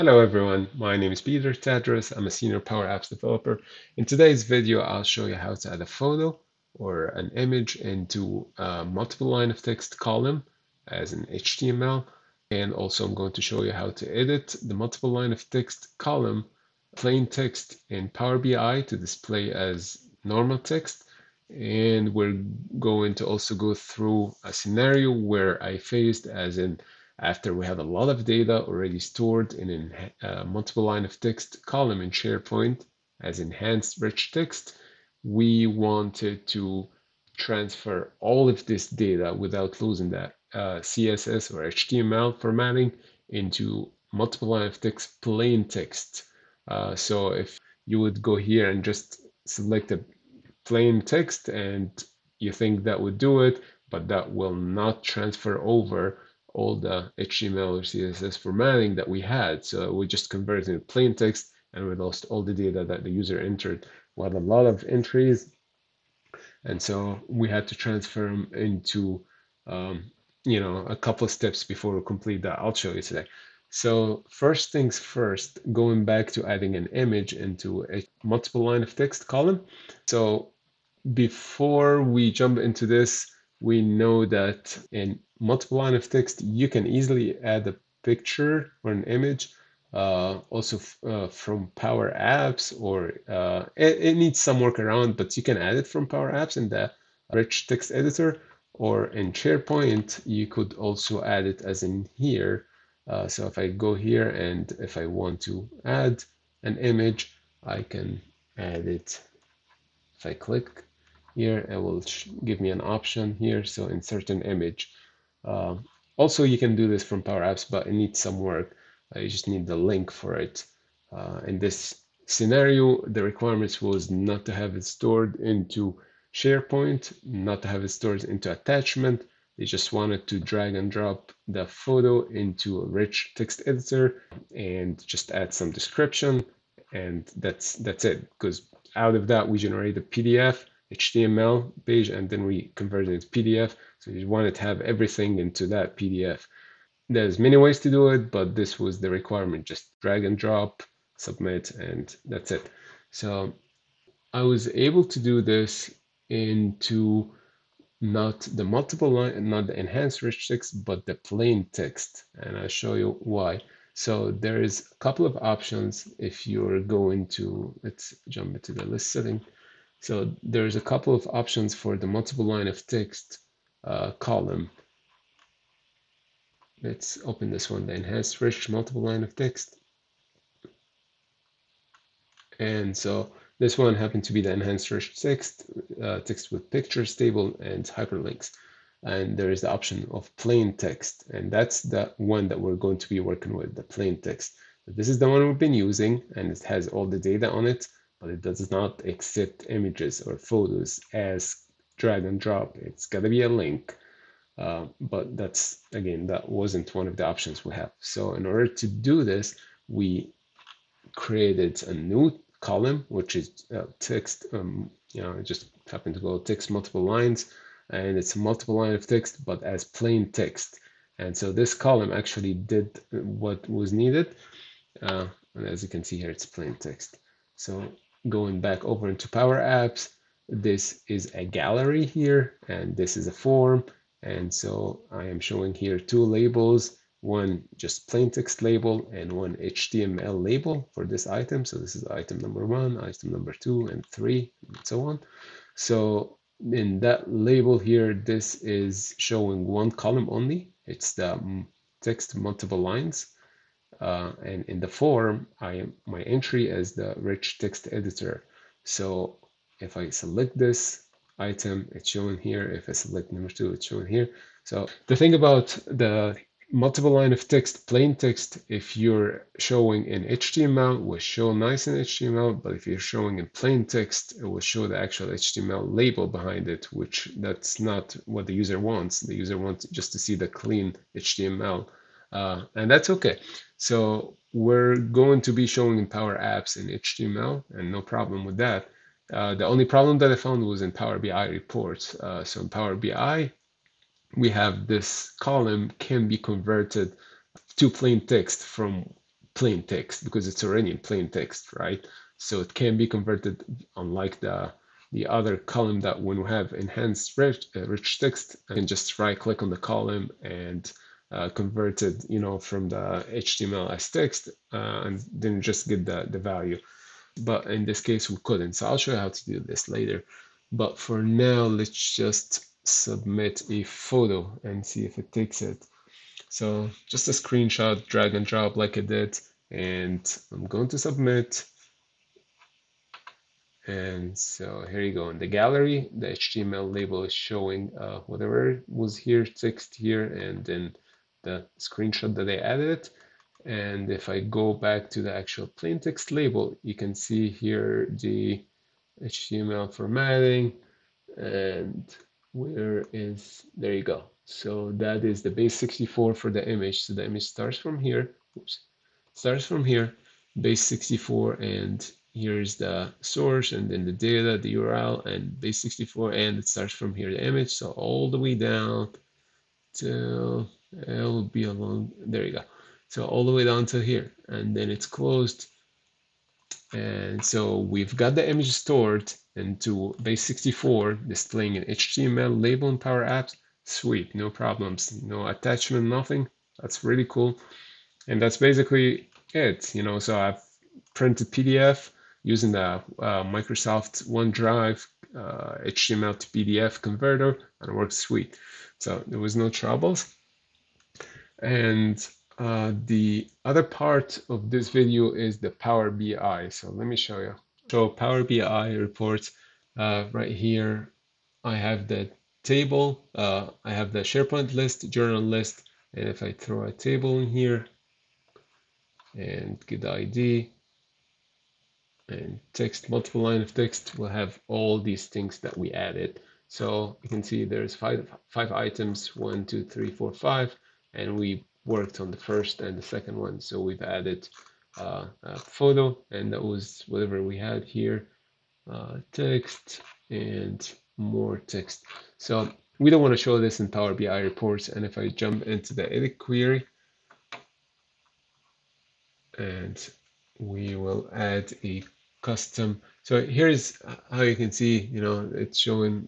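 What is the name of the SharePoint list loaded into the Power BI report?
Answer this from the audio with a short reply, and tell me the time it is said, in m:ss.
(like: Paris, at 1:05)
Journal list, at 6:55.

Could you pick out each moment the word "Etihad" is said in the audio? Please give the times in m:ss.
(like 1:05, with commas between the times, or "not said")
not said.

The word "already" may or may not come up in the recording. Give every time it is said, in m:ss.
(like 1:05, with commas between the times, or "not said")
0:28, 5:00.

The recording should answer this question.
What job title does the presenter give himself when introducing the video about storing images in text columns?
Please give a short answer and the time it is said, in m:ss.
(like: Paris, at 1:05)
Senior Power Apps developer, at 0:02.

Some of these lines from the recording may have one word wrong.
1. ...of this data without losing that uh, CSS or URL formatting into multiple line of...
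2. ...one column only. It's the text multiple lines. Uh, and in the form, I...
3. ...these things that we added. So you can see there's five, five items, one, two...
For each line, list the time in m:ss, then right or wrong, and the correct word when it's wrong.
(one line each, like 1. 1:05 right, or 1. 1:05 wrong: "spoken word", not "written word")
1. 0:38 wrong: "HTML", not "URL"
2. 4:09 right
3. 7:04 right.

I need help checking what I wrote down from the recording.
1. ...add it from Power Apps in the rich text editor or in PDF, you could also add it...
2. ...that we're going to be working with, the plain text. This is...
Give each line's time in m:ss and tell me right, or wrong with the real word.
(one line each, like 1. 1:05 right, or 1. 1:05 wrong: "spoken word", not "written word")
1. 1:35 wrong: "SharePoint", not "PDF"
2. 3:12 right.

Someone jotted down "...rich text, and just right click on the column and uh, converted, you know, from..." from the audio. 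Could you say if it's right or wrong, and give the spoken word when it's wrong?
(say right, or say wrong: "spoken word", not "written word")
right.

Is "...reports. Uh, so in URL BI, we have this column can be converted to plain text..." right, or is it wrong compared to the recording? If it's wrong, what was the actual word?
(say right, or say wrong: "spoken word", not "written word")
wrong: "Power", not "URL".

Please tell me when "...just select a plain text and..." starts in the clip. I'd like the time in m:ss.
0:48.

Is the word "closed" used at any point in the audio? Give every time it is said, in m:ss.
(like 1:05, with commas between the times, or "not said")
6:15.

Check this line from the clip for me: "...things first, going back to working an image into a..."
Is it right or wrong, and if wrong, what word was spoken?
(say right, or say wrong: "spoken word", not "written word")
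wrong: "adding", not "working".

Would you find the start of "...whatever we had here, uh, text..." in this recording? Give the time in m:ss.
7:17.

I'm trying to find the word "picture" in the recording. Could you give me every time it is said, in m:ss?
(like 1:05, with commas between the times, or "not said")
1:28, 3:06.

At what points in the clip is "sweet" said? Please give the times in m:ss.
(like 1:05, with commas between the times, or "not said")
6:23, 6:38.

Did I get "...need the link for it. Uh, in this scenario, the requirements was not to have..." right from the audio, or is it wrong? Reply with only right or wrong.
right.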